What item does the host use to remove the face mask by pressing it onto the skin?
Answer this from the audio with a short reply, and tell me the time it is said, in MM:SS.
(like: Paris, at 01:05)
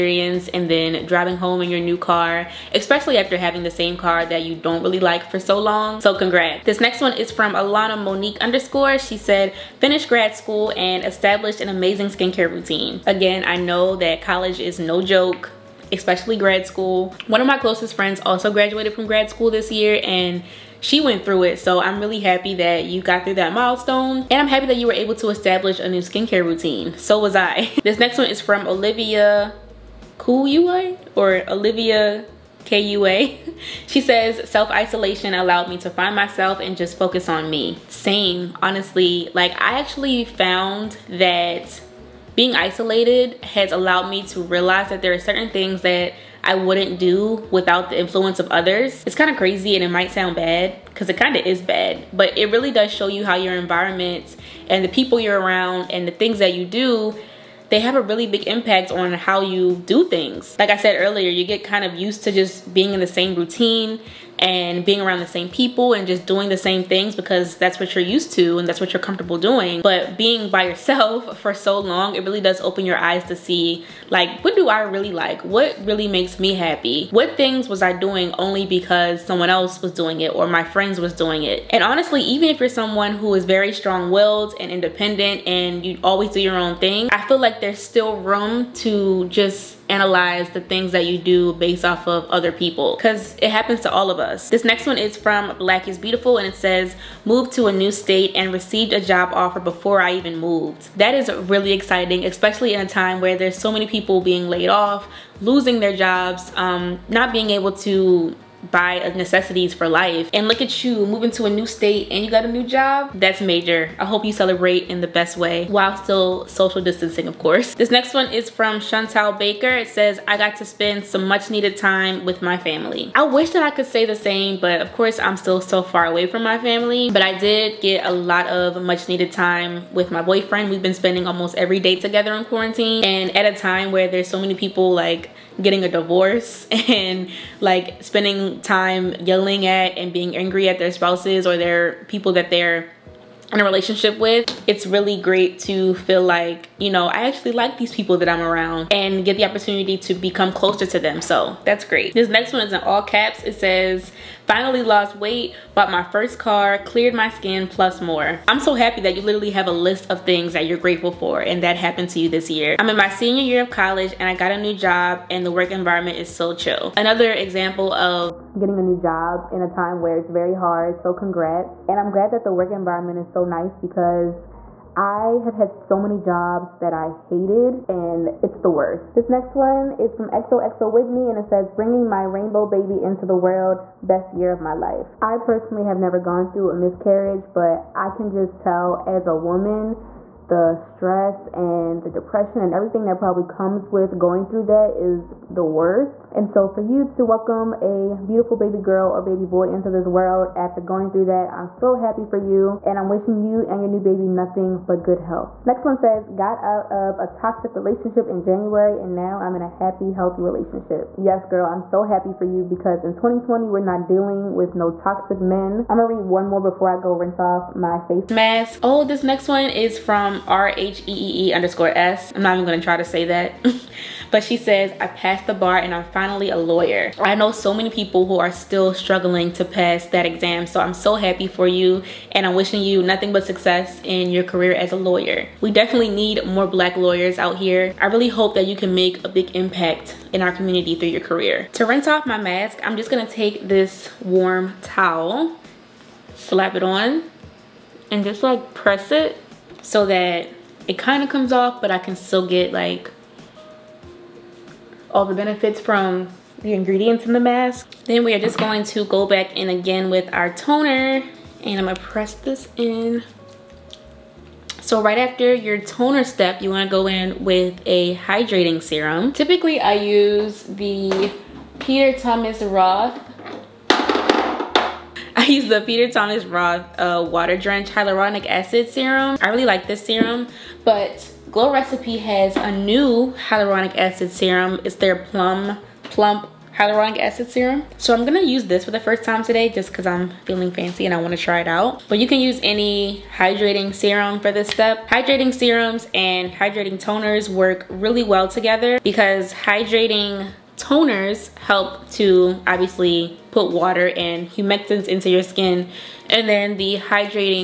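warm towel, at 04:04.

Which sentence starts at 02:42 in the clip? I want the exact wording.
I'm in my senior year of college and I got a new job and the work environment is so chill.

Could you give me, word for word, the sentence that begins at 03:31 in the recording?
Yes, girl, I'm so happy for you because in 2020, we're not dealing with no toxic men.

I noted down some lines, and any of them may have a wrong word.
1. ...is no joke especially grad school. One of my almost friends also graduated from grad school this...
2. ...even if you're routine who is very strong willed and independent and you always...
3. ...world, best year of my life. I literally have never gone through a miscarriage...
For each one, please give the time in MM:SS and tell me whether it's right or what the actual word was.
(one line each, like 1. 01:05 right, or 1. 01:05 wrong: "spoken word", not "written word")
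1. 00:14 wrong: "closest", not "almost"
2. 01:22 wrong: "someone", not "routine"
3. 03:03 wrong: "personally", not "literally".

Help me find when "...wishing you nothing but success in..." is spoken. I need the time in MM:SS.
03:52.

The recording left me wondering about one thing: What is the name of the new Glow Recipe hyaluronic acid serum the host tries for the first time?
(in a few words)
Plum Plump Hyaluronic Acid Serum.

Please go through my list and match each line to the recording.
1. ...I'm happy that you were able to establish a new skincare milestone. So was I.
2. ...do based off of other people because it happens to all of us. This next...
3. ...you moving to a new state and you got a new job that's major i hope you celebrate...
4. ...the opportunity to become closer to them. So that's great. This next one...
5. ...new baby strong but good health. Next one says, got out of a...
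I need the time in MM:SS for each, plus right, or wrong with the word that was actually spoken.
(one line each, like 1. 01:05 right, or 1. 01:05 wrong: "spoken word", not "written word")
1. 00:24 wrong: "routine", not "milestone"
2. 01:31 right
3. 01:50 right
4. 02:29 right
5. 03:23 wrong: "nothing", not "strong".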